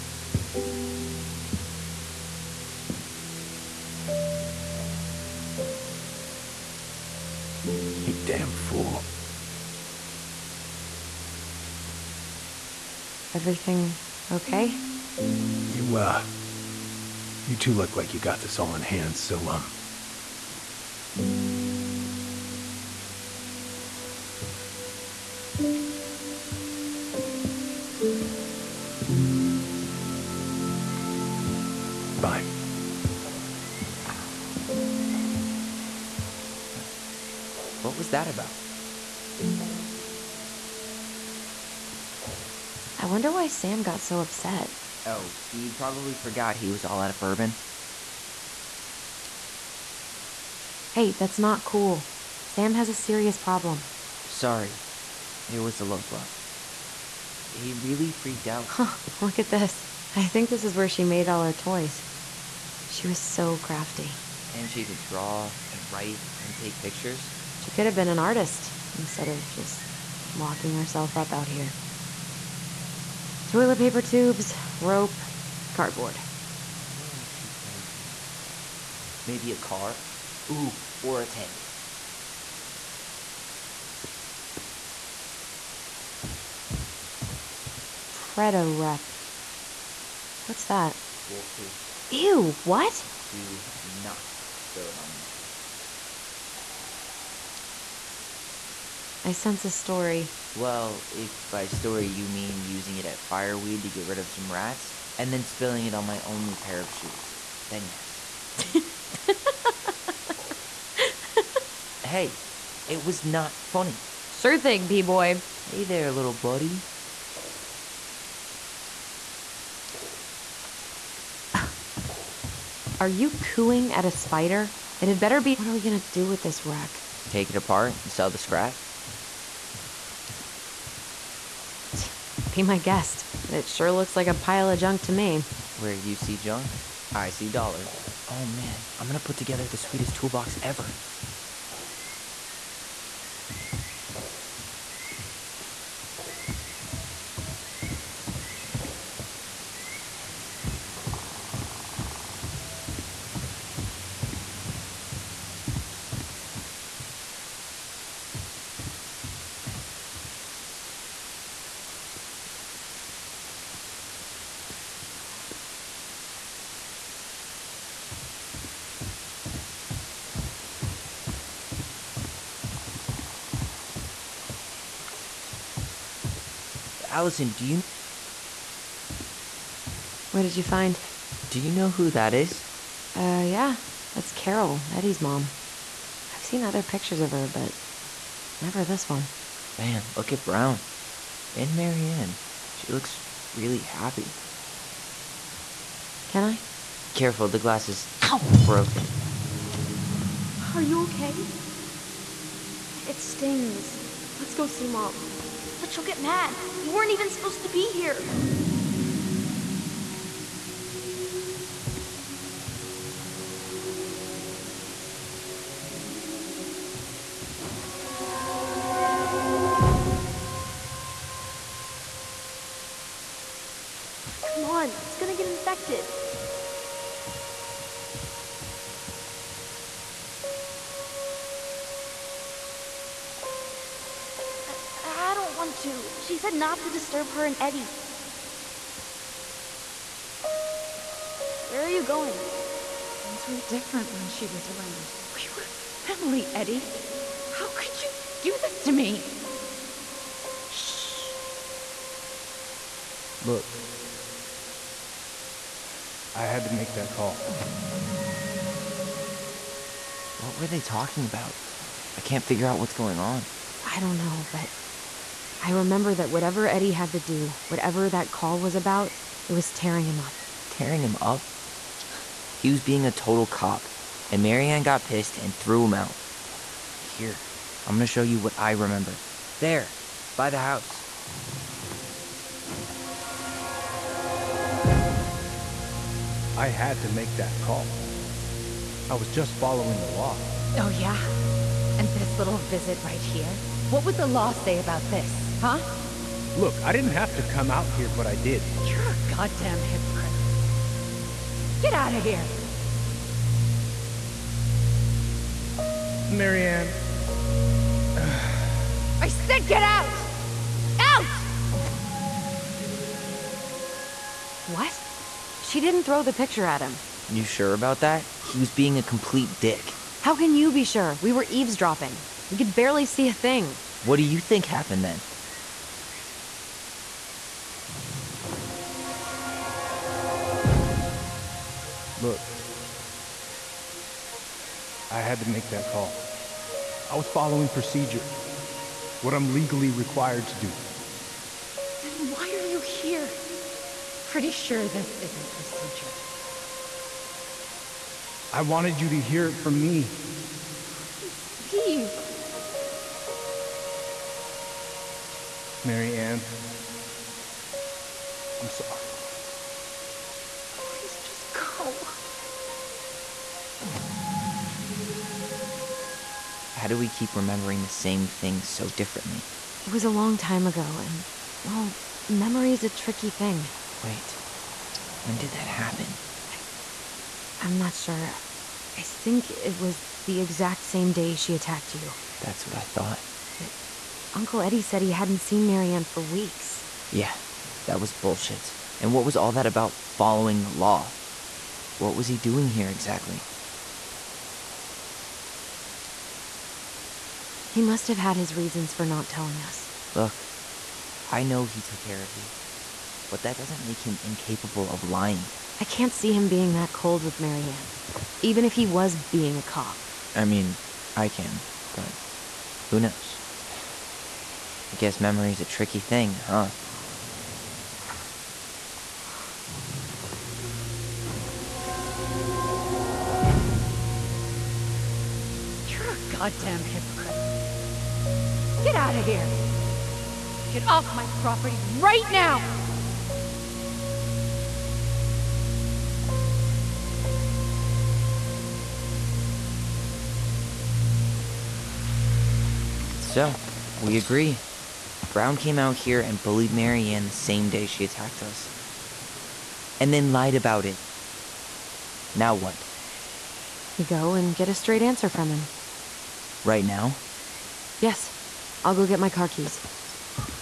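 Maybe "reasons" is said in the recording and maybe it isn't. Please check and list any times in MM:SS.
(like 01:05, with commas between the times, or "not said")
06:38.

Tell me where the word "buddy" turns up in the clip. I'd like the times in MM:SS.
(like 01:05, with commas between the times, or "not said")
01:56.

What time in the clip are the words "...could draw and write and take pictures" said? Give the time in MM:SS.
01:04.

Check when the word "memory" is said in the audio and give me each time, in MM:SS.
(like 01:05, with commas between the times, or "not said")
06:12, 06:55.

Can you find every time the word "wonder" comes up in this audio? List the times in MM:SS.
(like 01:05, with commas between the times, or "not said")
00:43, 01:16.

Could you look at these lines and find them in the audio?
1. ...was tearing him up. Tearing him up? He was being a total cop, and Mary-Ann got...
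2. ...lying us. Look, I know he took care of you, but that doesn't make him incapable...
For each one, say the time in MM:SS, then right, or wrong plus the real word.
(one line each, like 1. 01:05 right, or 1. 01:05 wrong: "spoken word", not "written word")
1. 04:29 right
2. 06:39 wrong: "telling", not "lying".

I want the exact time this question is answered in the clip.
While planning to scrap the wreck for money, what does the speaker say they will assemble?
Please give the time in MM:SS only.
02:20.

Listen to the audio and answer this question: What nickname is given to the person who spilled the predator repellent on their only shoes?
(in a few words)
P boy.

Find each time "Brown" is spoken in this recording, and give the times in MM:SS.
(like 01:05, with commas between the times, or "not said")
03:10, 07:25.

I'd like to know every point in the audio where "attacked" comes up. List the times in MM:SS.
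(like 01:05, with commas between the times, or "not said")
06:21, 07:28.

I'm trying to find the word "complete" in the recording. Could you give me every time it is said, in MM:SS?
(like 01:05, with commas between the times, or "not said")
05:19.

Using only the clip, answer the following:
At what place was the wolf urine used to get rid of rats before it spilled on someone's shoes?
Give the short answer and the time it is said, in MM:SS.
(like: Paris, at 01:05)
Fireweed, at 01:43.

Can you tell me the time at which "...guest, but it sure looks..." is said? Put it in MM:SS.
02:12.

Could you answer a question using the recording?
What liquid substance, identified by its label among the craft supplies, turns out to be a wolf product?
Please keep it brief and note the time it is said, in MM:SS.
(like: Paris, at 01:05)
Wolf pee, at 01:31.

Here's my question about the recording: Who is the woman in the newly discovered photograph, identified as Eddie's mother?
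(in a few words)
Carol.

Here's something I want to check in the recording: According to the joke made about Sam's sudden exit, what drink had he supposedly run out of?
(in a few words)
Bourbon.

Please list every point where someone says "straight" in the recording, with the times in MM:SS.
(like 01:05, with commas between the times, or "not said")
07:34.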